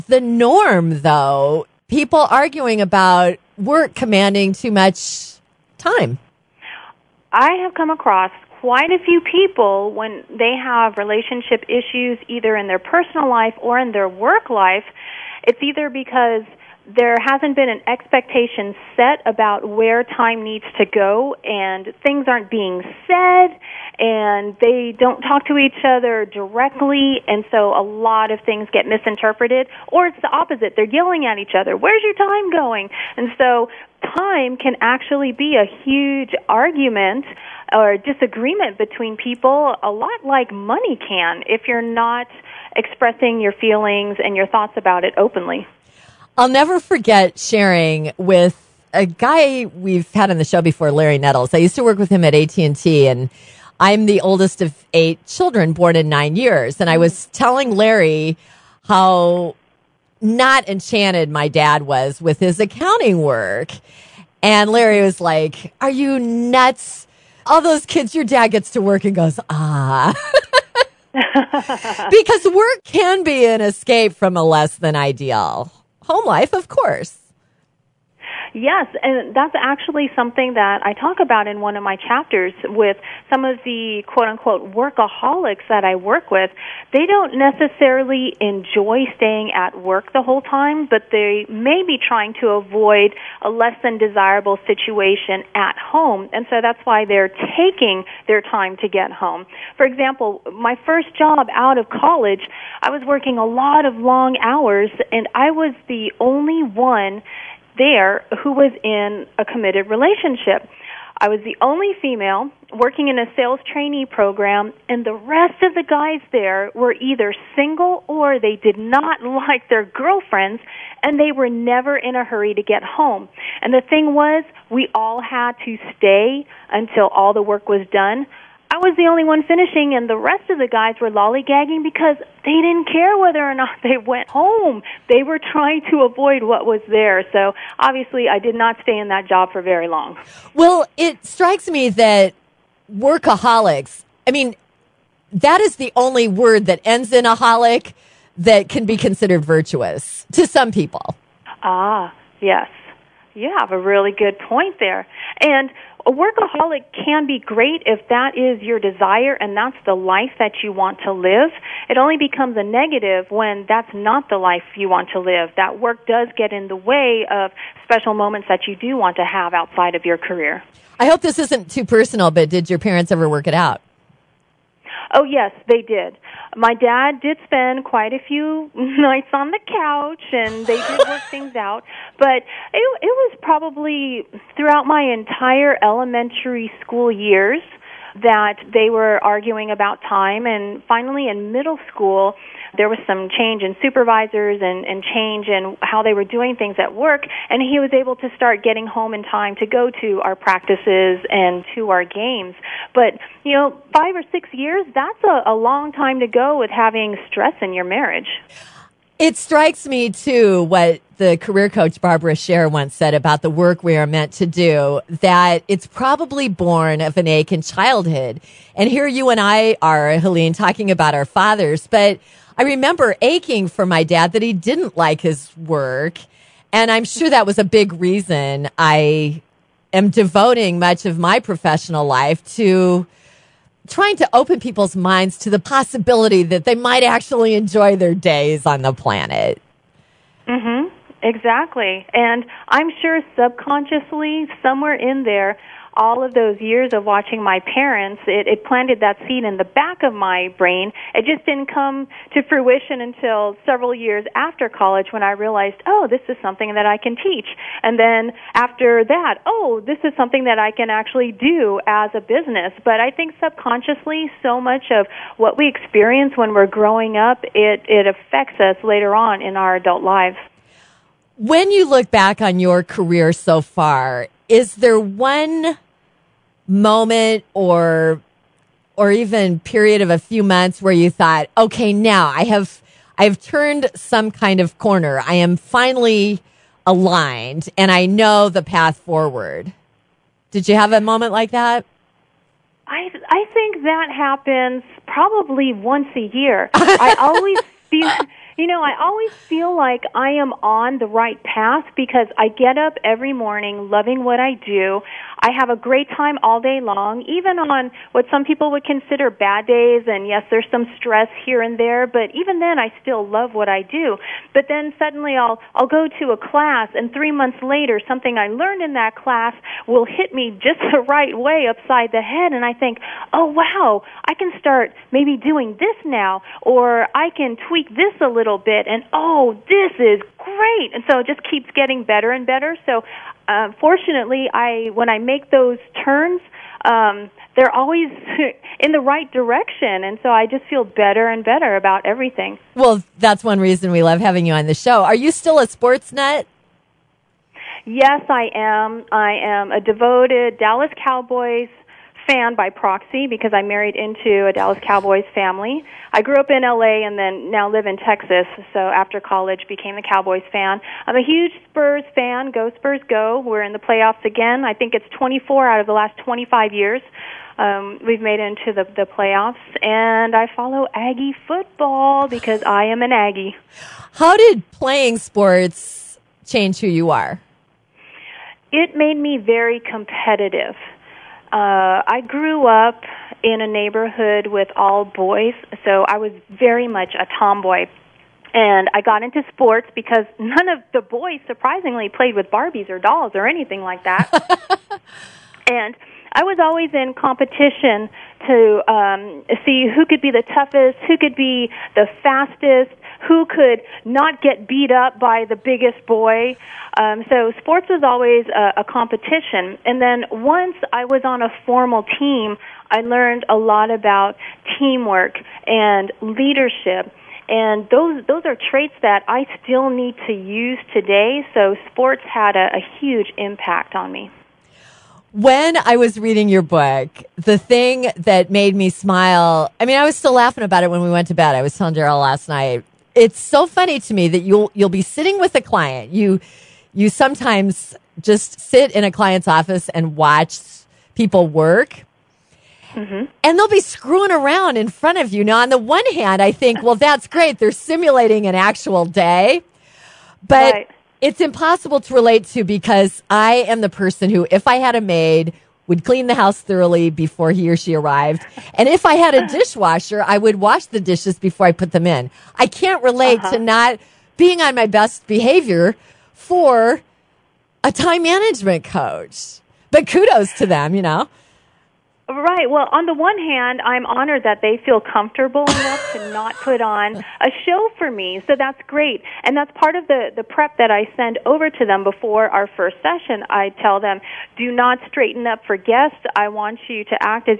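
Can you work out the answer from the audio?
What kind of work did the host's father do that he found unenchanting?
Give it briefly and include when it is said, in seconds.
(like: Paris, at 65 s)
accounting, at 62 s.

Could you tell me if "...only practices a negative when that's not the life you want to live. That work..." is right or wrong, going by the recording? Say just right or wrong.
wrong.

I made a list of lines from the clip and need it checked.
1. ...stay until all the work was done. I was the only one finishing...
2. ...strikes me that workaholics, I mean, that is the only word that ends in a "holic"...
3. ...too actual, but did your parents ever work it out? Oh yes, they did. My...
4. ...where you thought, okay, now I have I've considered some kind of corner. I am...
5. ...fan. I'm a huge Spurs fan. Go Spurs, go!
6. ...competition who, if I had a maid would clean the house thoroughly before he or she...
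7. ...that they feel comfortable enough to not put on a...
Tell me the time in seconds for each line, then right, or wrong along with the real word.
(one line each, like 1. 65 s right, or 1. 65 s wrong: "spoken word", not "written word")
1. 125 s right
2. 141 s right
3. 171 s wrong: "personal", not "actual"
4. 280 s wrong: "turned", not "considered"
5. 360 s right
6. 453 s wrong: "person", not "competition"
7. 474 s right.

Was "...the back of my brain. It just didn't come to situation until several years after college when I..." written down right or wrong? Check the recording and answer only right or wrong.
wrong.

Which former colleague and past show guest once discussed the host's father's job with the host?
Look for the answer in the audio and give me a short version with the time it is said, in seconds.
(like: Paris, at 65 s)
Larry Nettles, at 50 s.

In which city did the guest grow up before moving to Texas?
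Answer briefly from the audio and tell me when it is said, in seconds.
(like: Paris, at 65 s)
LA, at 356 s.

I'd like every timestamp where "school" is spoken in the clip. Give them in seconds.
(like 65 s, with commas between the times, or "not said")
186 s, 191 s.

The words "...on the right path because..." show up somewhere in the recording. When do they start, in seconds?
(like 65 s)
300 s.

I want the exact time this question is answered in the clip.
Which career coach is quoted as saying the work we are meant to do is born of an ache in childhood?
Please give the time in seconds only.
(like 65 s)
212 s.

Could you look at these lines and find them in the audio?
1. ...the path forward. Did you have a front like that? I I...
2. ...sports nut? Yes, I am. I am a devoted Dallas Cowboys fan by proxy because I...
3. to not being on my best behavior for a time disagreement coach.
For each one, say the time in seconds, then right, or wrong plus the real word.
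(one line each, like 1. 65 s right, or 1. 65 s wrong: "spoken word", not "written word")
1. 288 s wrong: "moment", not "front"
2. 345 s right
3. 463 s wrong: "management", not "disagreement".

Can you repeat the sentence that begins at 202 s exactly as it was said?
But, you know, five or six years, that's a, a long time to go with having stress in your marriage.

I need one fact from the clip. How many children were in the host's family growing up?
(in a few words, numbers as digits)
8.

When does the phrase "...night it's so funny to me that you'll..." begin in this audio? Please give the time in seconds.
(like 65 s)
432 s.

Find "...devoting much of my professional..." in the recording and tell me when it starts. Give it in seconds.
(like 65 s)
230 s.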